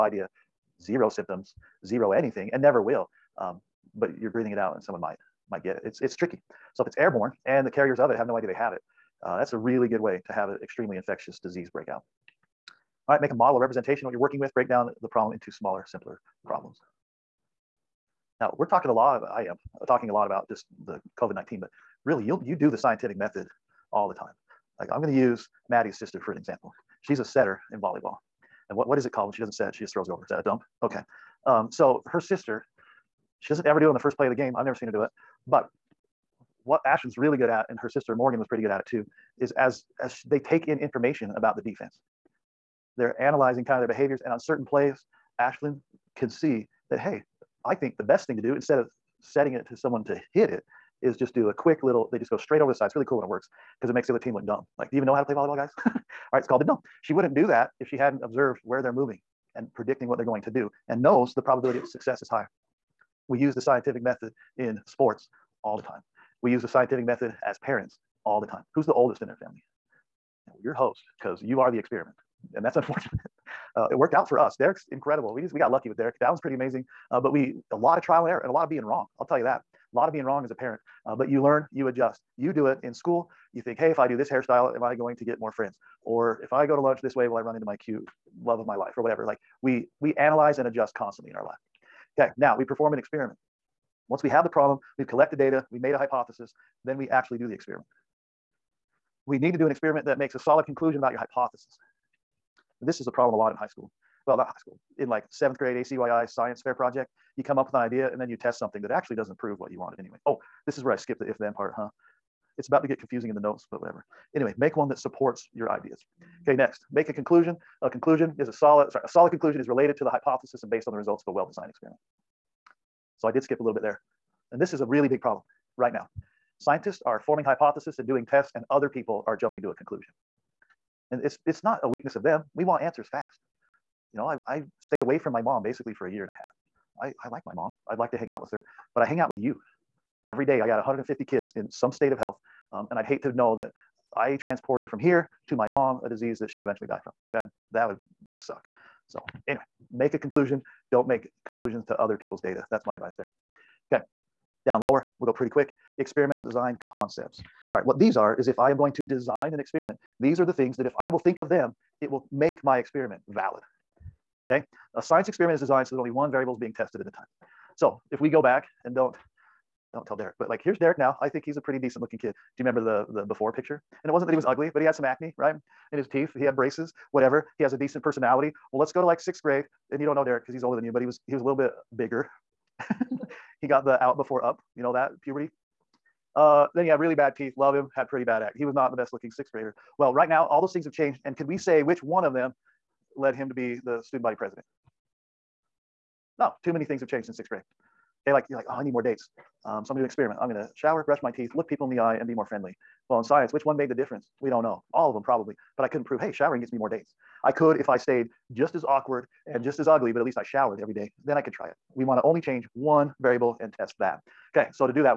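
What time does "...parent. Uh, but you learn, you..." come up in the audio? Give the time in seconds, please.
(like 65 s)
80 s.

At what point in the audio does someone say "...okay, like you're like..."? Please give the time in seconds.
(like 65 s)
198 s.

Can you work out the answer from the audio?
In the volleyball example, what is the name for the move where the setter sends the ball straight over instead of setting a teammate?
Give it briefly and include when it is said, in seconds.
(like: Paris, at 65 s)
The dump, at 56 s.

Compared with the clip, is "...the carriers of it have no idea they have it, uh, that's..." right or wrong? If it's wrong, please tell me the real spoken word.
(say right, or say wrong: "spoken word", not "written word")
right.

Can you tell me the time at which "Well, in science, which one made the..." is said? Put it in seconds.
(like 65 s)
203 s.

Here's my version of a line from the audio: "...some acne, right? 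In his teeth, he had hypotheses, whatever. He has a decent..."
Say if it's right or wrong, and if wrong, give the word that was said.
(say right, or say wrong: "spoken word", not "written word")
wrong: "braces", not "hypotheses".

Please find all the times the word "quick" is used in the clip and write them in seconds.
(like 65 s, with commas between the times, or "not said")
51 s, 155 s.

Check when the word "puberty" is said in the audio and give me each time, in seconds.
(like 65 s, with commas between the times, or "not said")
185 s.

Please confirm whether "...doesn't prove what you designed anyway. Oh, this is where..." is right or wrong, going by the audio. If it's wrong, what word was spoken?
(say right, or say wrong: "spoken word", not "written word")
wrong: "wanted", not "designed".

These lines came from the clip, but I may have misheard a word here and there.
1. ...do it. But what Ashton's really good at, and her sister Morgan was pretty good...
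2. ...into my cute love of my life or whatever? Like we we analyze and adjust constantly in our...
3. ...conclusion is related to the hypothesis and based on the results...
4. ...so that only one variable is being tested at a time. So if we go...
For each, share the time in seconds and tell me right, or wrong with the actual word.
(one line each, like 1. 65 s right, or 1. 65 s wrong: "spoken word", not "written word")
1. 34 s right
2. 87 s right
3. 119 s right
4. 165 s right.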